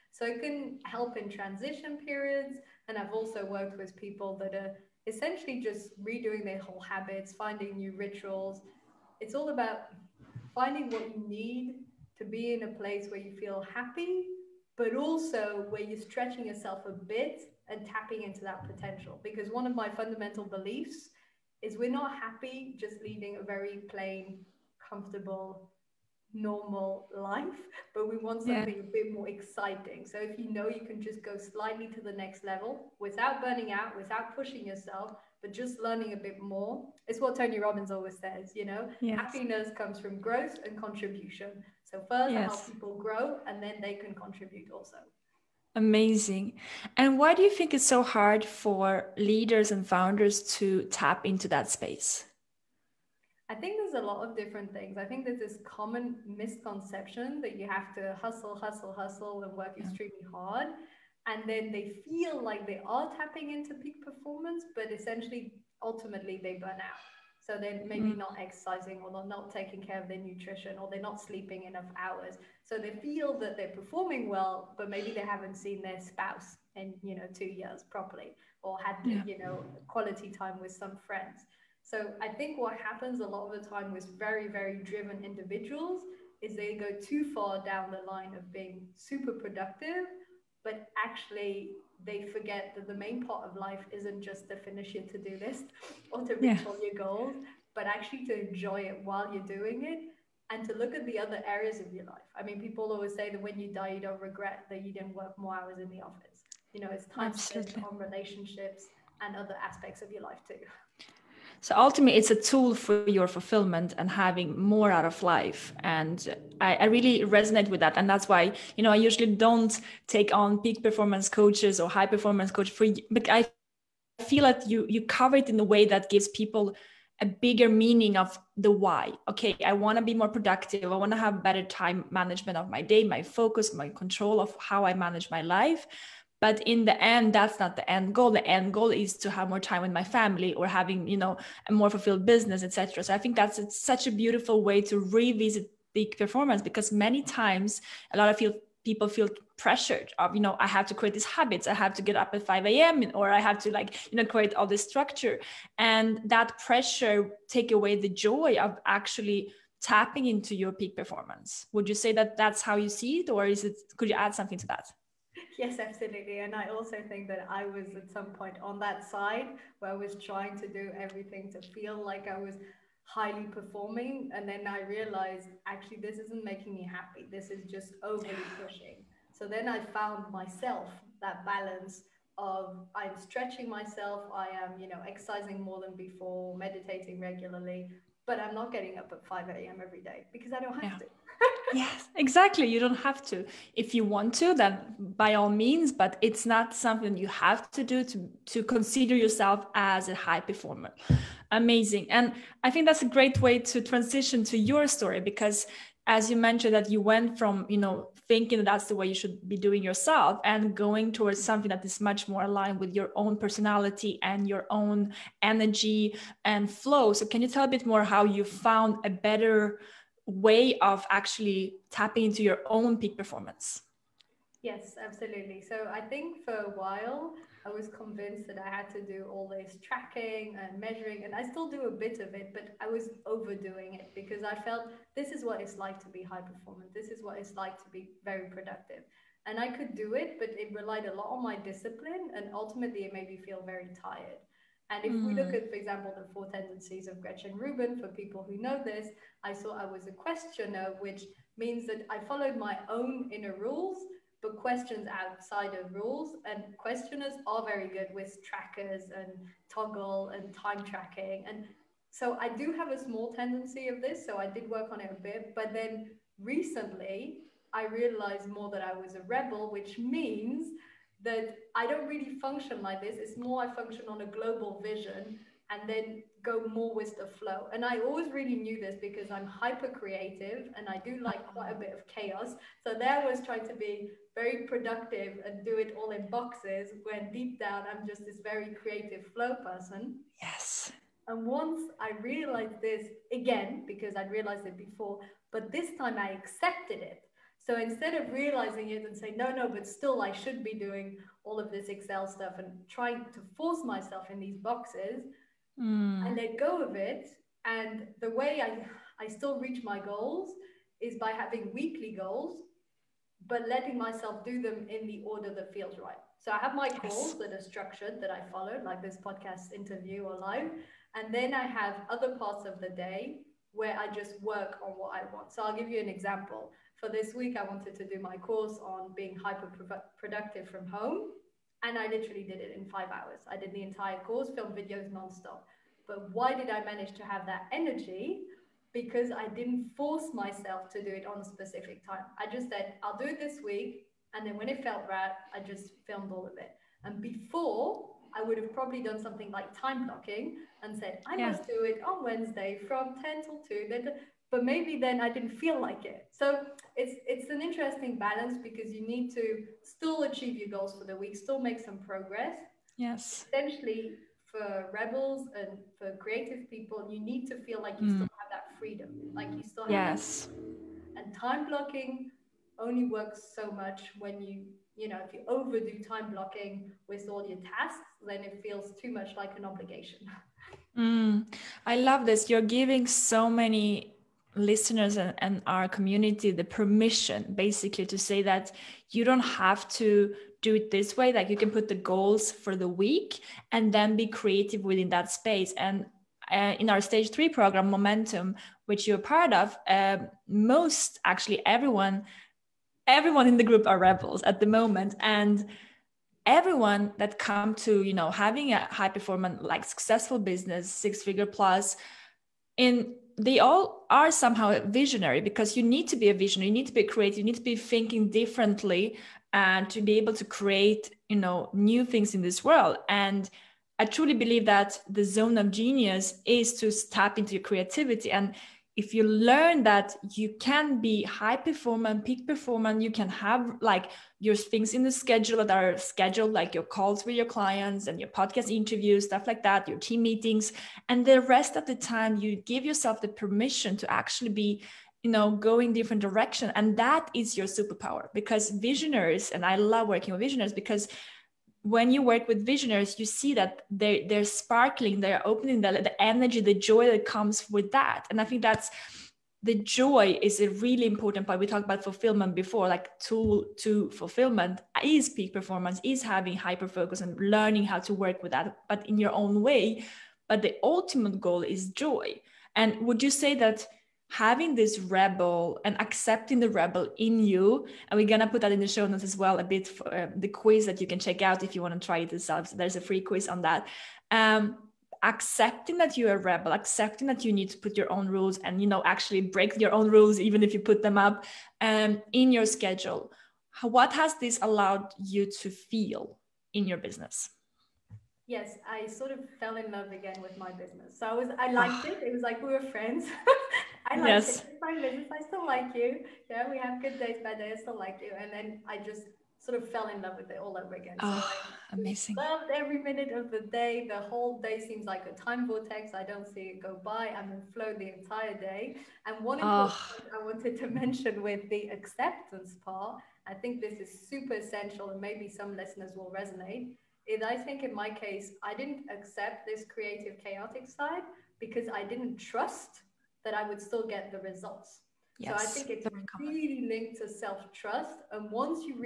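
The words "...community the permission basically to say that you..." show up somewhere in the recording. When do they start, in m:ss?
6:25.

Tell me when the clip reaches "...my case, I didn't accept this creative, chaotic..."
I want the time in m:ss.
8:47.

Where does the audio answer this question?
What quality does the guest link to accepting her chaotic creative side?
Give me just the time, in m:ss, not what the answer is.
8:57.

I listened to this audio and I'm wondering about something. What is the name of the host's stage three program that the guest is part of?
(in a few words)
Momentum.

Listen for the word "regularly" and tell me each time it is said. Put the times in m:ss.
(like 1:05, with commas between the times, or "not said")
3:07.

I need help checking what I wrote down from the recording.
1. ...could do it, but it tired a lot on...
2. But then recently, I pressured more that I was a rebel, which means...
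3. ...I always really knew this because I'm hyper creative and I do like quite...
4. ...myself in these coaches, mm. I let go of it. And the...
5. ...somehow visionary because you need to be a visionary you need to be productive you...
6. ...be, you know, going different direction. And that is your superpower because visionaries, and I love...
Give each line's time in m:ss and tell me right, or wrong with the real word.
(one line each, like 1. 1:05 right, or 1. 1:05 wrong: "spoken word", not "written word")
1. 3:59 wrong: "relied", not "tired"
2. 4:25 wrong: "realized", not "pressured"
3. 4:37 right
4. 5:03 wrong: "boxes", not "coaches"
5. 6:54 wrong: "creative", not "productive"
6. 7:24 right.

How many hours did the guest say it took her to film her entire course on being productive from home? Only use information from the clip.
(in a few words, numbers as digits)
5.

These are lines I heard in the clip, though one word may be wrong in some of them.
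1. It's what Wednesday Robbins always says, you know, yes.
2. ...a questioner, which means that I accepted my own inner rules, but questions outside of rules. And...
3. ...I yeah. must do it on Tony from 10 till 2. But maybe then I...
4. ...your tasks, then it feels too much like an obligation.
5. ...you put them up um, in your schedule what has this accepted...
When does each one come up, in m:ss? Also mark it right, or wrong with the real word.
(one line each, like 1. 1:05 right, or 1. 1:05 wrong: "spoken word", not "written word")
1. 0:37 wrong: "Tony", not "Wednesday"
2. 4:10 wrong: "followed", not "accepted"
3. 5:51 wrong: "Wednesday", not "Tony"
4. 6:17 right
5. 8:10 wrong: "allowed", not "accepted".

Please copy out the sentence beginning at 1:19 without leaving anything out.
you know, quality time with some friends.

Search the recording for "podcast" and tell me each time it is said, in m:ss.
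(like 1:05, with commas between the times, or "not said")
5:19, 7:18.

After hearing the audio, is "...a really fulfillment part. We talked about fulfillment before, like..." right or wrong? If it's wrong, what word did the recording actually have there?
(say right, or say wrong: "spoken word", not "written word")
wrong: "important", not "fulfillment".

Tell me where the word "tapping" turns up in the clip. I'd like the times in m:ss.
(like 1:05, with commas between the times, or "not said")
0:17, 1:03, 2:39, 3:41.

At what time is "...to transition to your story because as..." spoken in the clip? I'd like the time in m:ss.
3:23.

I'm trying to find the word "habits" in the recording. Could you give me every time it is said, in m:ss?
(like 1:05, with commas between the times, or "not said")
0:06, 2:31.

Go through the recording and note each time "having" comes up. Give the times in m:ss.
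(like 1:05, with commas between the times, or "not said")
1:54, 2:20, 5:11, 6:48, 7:46, 7:54.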